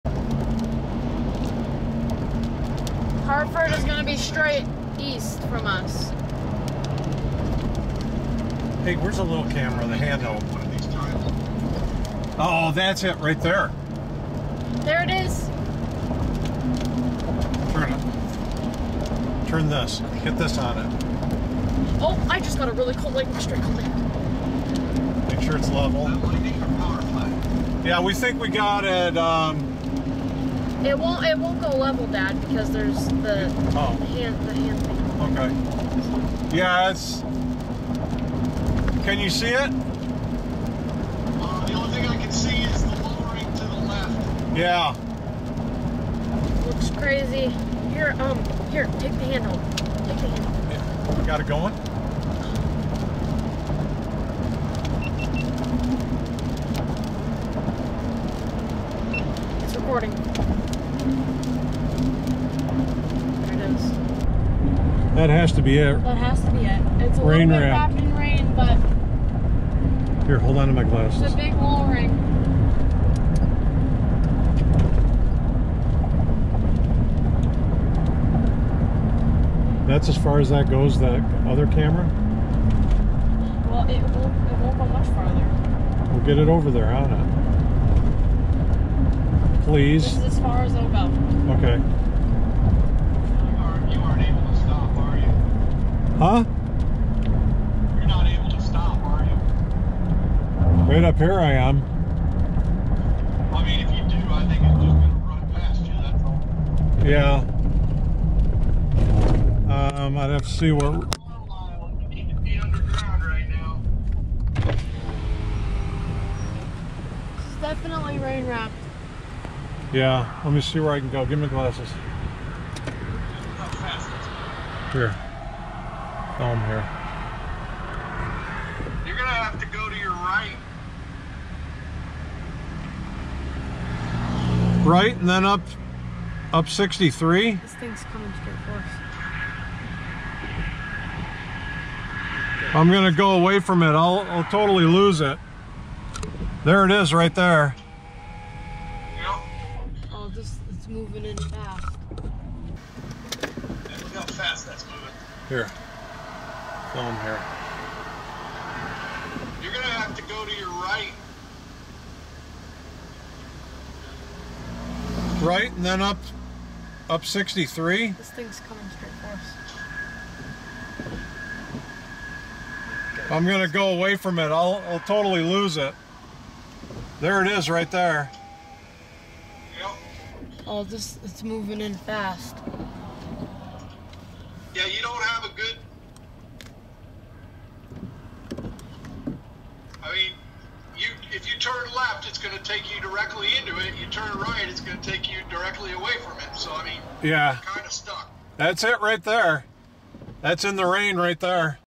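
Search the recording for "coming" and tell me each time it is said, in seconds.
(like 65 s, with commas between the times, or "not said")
138 s, 168 s.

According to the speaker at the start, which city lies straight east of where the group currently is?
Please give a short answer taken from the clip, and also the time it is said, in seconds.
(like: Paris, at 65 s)
Hartford, at 3 s.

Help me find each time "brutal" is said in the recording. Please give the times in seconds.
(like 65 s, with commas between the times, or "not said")
not said.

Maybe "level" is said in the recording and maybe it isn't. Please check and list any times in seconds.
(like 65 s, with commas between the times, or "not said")
25 s, 31 s.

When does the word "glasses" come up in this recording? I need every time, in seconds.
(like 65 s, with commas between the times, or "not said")
70 s, 121 s.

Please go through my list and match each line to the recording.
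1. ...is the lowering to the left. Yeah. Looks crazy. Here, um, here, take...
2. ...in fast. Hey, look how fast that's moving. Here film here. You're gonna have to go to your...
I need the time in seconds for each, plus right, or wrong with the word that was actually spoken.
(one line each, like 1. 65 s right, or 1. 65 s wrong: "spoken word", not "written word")
1. 42 s right
2. 151 s right.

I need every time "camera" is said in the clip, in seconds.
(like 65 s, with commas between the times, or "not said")
9 s, 81 s.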